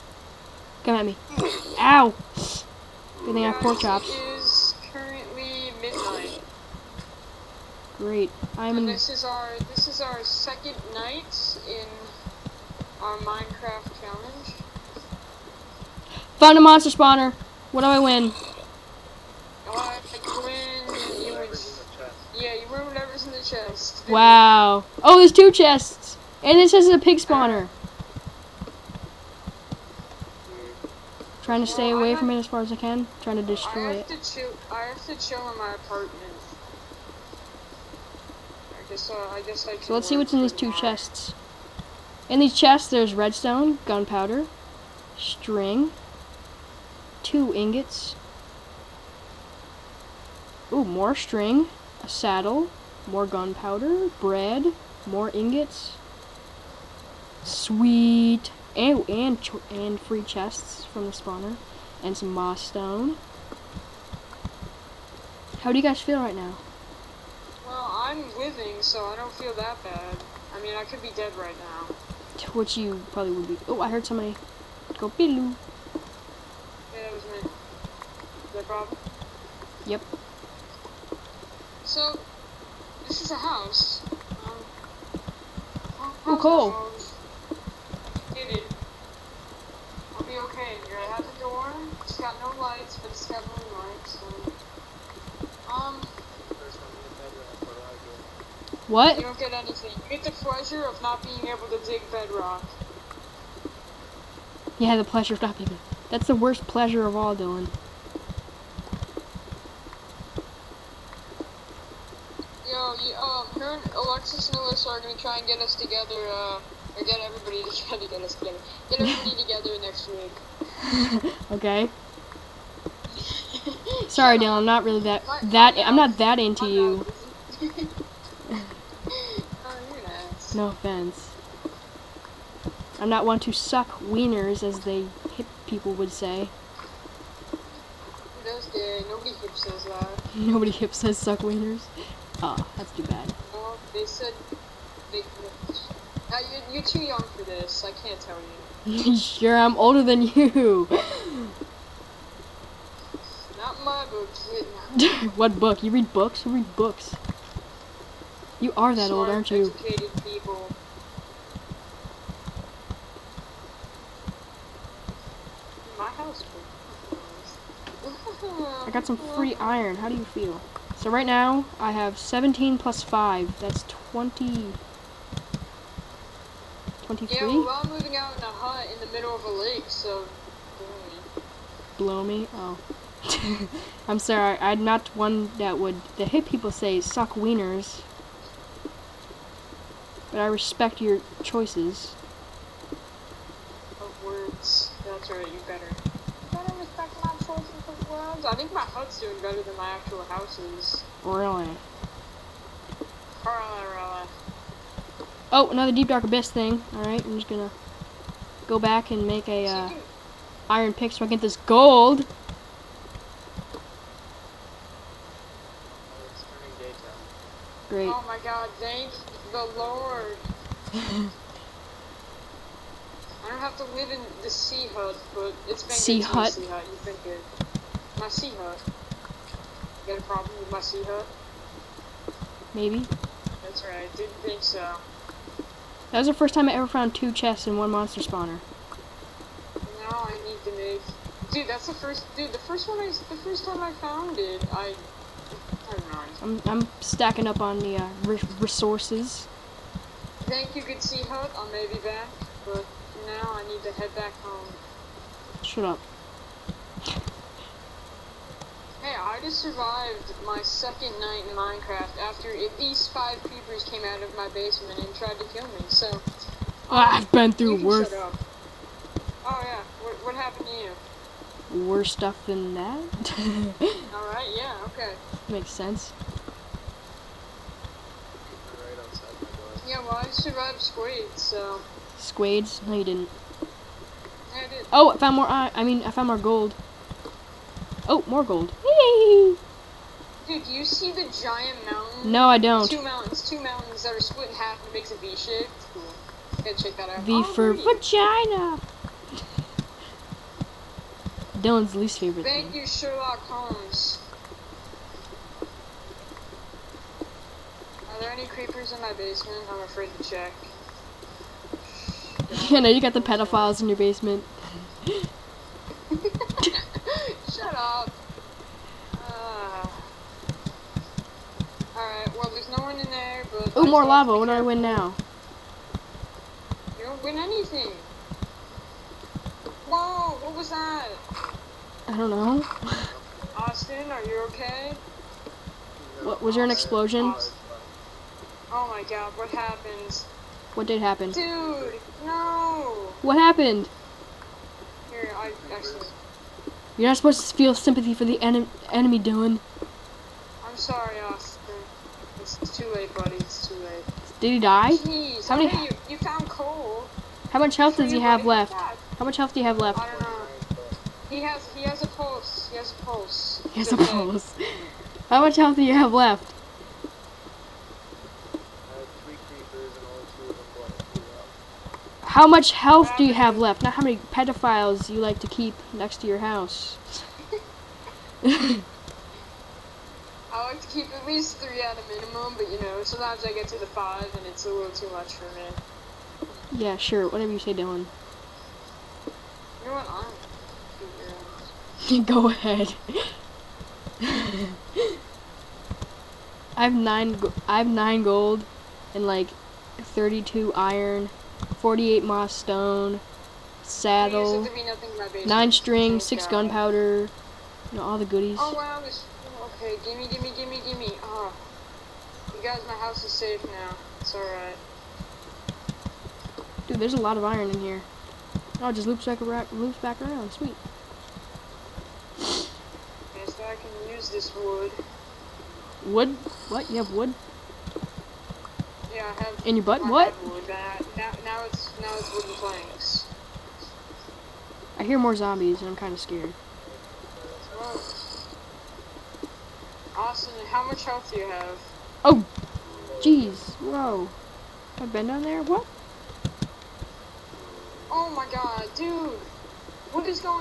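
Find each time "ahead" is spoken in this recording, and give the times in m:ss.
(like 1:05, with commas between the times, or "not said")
6:32.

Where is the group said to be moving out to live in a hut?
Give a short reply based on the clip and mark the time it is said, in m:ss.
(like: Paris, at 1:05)
Middle of a lake, at 2:58.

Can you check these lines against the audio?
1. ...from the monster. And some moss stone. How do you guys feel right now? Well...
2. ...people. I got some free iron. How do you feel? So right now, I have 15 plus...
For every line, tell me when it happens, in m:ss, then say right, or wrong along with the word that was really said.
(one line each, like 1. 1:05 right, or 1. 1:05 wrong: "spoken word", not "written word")
1. 1:00 wrong: "spawner", not "monster"
2. 2:40 wrong: "17", not "15".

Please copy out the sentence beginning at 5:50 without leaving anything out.
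I'm sorry, Austin too late, buddy.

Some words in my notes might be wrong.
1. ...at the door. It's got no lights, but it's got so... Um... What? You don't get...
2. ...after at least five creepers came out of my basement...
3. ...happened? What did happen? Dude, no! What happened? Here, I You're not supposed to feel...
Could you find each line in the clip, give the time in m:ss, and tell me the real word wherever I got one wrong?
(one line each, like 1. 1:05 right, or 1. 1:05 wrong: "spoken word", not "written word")
1. 1:31 right
2. 4:22 right
3. 5:39 right.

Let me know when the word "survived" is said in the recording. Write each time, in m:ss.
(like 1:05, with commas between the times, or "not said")
4:19, 4:40.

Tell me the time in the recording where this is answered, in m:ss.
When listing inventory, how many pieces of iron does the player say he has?
6:39.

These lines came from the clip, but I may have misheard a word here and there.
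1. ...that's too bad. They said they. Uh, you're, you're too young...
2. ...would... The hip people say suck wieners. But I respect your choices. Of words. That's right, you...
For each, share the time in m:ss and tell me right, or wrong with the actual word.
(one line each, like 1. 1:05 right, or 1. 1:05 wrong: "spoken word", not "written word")
1. 2:22 right
2. 3:05 right.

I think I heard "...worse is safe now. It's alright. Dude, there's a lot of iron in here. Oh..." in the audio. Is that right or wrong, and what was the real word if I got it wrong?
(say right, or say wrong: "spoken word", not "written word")
wrong: "house", not "worse".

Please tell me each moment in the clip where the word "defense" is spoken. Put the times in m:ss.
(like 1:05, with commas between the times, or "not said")
not said.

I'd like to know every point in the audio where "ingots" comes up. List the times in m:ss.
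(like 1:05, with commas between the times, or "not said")
0:47, 0:55.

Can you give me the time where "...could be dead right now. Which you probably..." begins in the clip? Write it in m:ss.
1:10.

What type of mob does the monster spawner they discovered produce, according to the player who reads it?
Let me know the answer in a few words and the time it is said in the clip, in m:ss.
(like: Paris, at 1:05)
Pig, at 0:26.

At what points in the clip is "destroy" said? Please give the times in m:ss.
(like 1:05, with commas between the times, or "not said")
0:33.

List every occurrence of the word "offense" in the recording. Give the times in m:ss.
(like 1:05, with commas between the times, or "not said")
2:10.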